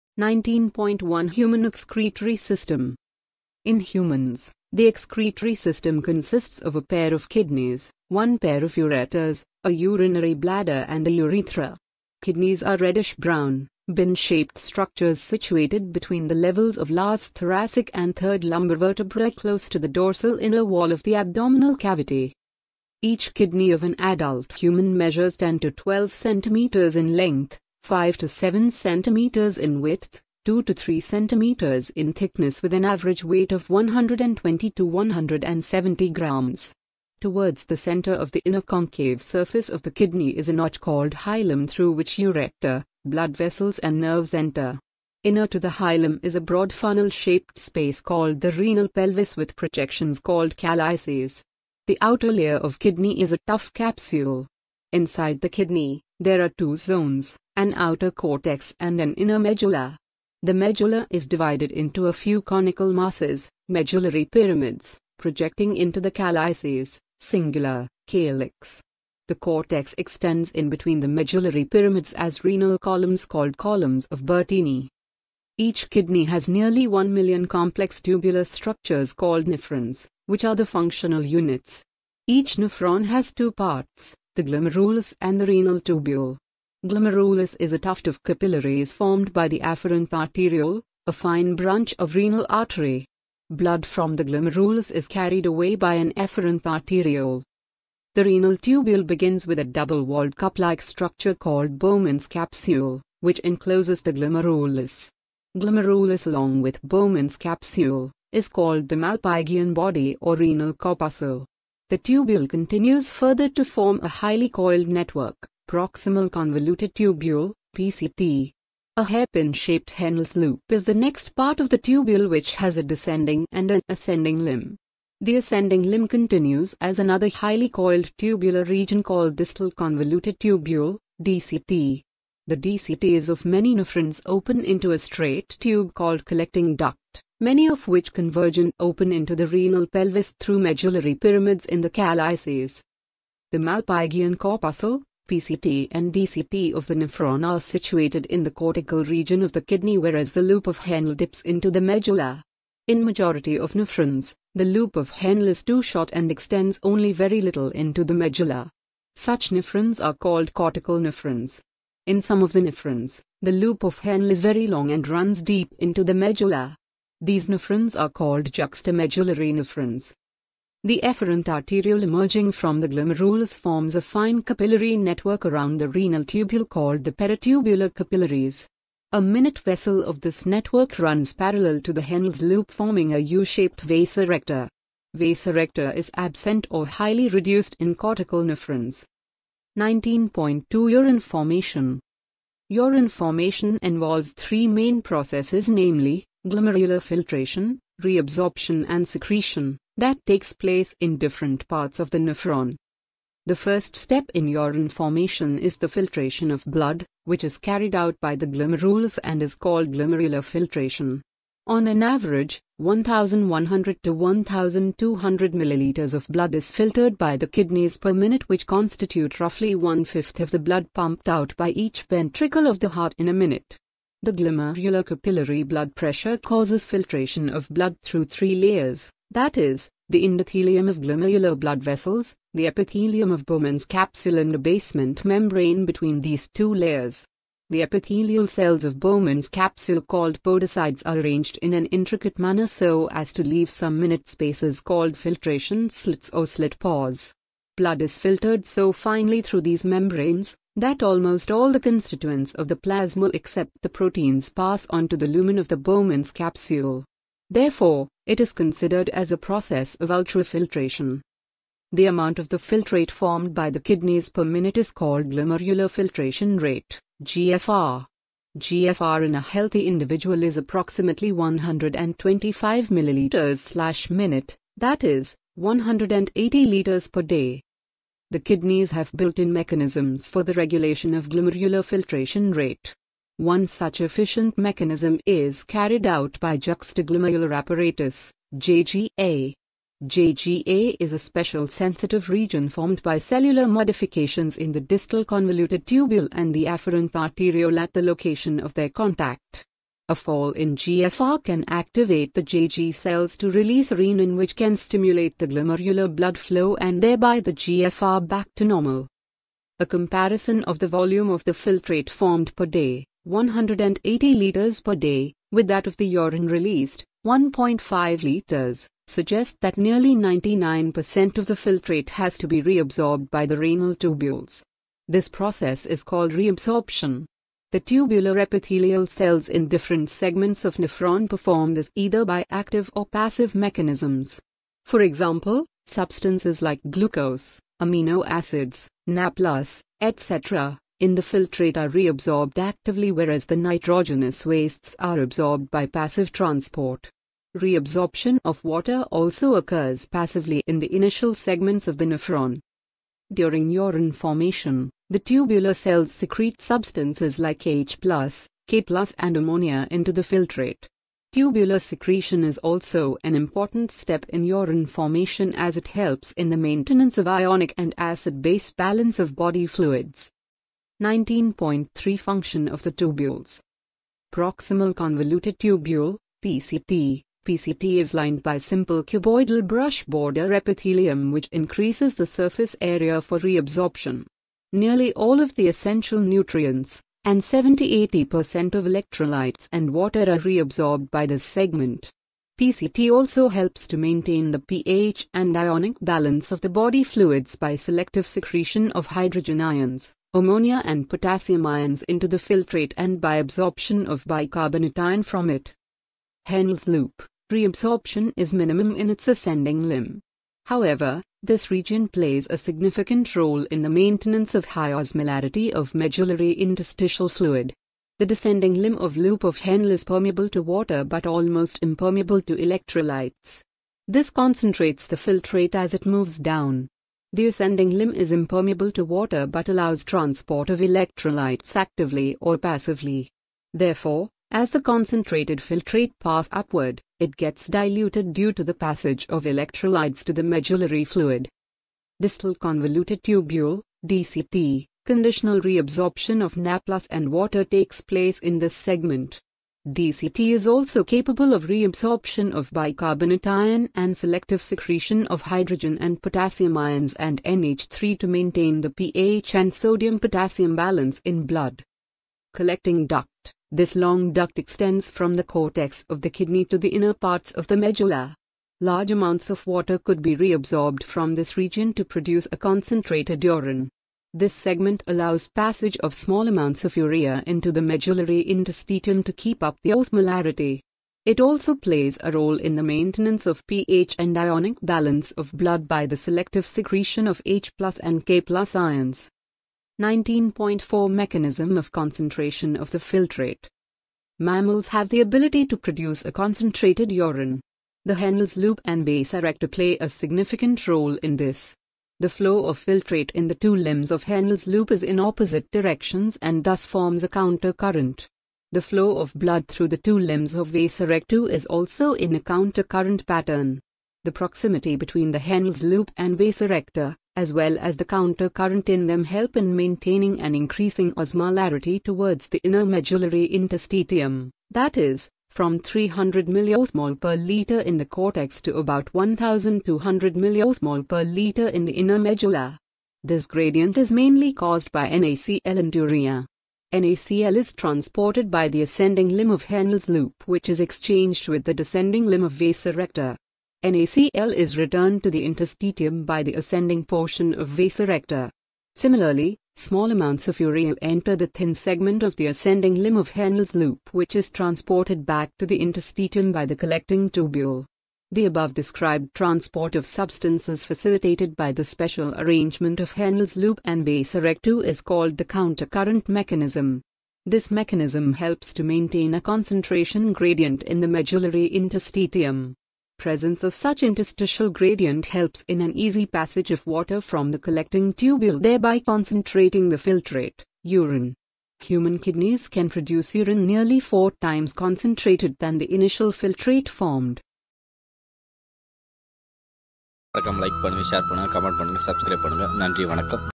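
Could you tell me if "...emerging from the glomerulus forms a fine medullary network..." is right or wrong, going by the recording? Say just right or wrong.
wrong.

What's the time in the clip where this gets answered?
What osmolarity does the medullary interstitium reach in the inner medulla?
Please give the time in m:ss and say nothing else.
8:49.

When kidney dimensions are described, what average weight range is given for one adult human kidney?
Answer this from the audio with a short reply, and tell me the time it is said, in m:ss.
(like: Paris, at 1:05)
120 to 170 grams, at 0:33.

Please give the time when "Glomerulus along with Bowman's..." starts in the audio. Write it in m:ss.
1:45.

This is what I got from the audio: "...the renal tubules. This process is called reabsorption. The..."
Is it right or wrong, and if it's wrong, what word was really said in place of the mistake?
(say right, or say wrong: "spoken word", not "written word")
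right.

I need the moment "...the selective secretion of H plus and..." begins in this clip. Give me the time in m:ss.
8:06.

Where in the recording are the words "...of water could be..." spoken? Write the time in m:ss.
7:49.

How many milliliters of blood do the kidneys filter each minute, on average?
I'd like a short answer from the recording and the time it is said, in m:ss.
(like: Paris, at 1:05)
1100 to 1200 milliliters, at 3:32.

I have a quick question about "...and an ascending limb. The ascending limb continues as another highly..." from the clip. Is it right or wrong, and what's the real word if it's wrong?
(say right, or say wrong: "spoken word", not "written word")
right.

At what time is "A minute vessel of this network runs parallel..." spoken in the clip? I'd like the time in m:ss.
2:59.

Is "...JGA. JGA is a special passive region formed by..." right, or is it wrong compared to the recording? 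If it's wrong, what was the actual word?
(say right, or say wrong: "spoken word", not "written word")
wrong: "sensitive", not "passive".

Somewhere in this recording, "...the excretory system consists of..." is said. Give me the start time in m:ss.
0:04.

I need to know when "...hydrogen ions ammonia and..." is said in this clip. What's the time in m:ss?
6:39.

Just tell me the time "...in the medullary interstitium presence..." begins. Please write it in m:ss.
9:30.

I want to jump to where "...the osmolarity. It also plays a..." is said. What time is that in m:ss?
7:59.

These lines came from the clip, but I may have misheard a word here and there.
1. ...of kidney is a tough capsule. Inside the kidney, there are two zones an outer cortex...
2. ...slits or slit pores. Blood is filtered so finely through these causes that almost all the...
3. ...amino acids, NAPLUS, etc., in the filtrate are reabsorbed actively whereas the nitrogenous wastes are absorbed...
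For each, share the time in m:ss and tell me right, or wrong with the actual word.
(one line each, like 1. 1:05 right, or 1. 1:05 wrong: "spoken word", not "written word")
1. 0:52 right
2. 4:05 wrong: "membranes", not "causes"
3. 5:37 right.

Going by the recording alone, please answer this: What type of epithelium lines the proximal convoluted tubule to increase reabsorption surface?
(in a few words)
simple cuboidal brush border.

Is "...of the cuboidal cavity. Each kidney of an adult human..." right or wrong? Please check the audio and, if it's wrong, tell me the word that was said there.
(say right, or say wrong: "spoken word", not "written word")
wrong: "abdominal", not "cuboidal".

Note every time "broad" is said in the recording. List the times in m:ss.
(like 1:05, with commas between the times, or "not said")
0:46.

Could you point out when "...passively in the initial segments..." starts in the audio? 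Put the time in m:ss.
5:50.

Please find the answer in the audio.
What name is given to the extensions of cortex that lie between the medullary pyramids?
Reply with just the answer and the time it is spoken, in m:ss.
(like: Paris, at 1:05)
columns of Bertini, at 1:13.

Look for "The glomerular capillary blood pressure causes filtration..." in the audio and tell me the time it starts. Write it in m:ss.
3:44.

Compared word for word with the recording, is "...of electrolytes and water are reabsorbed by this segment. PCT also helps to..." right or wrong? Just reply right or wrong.
right.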